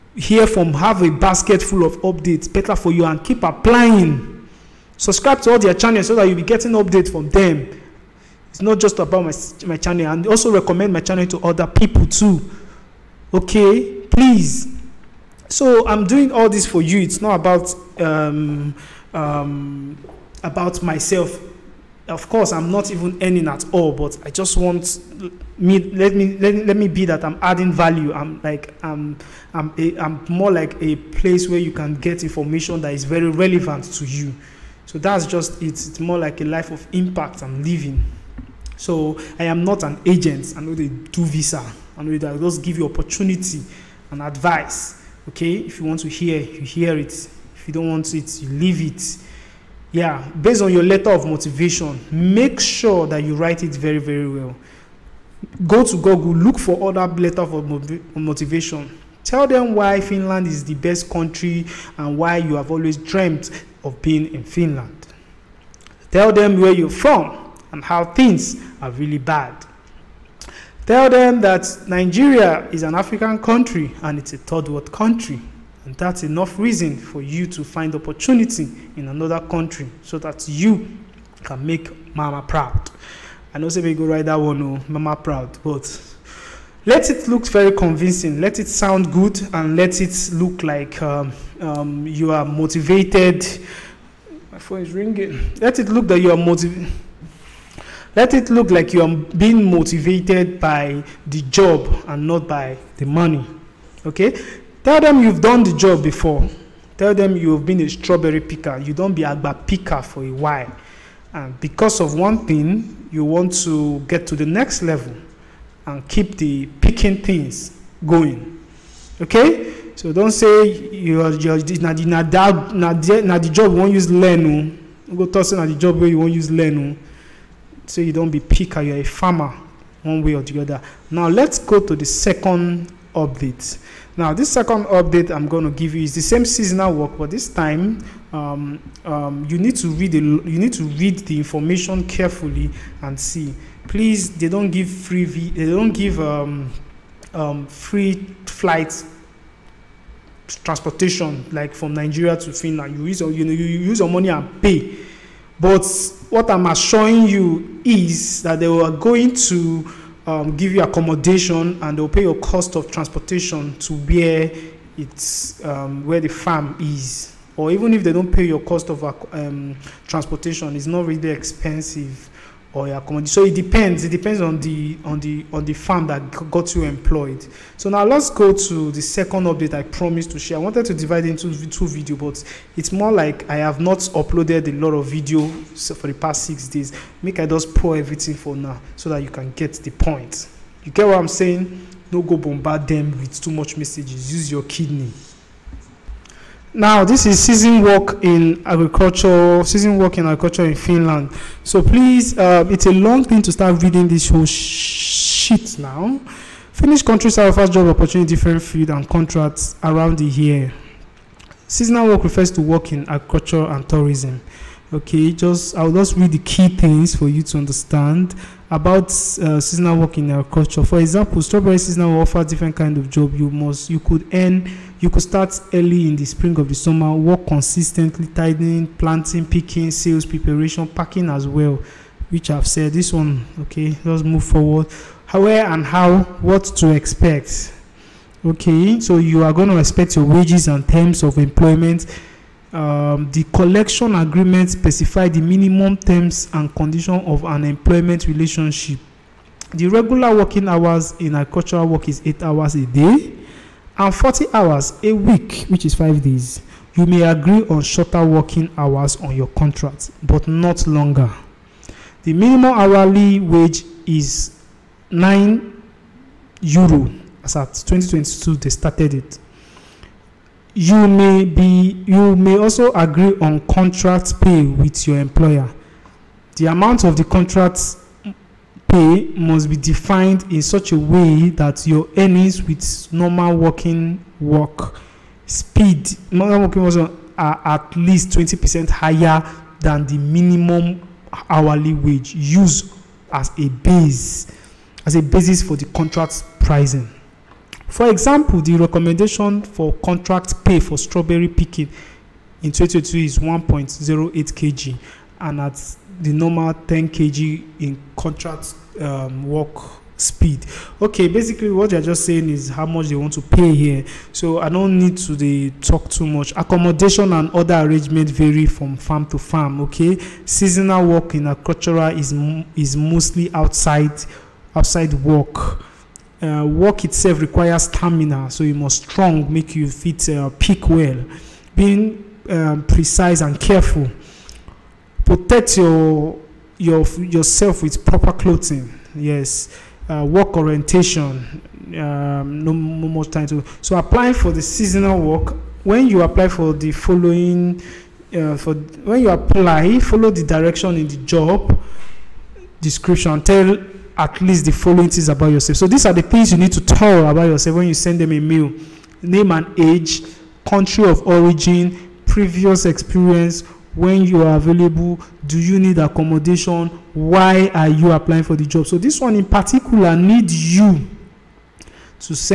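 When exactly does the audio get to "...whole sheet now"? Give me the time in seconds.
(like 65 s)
204 s.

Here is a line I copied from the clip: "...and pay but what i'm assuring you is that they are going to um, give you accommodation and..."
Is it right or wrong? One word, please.
right.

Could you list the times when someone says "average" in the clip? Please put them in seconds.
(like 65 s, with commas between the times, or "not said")
not said.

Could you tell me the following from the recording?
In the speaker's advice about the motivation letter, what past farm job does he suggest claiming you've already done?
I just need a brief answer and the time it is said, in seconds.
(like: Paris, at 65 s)
strawberry picker, at 107 s.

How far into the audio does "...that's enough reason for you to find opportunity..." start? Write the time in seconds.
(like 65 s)
75 s.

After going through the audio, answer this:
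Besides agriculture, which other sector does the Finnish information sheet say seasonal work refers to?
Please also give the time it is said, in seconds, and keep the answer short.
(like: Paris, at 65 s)
tourism, at 213 s.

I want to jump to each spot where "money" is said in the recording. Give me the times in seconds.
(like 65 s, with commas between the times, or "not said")
103 s, 154 s.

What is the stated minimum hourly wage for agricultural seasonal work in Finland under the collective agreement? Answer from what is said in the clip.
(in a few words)
9 euro.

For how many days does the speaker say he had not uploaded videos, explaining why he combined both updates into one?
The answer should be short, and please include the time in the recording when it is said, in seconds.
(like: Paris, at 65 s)
6 days, at 186 s.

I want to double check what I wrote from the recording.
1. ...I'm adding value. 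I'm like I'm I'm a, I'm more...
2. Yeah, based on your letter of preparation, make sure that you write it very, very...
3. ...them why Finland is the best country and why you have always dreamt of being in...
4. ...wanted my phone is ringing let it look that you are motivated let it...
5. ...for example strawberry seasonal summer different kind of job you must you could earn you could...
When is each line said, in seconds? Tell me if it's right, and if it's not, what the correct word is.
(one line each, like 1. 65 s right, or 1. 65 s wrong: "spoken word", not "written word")
1. 27 s right
2. 49 s wrong: "motivation", not "preparation"
3. 59 s right
4. 92 s wrong: "motivated", not "wanted"
5. 220 s wrong: "offer", not "summer".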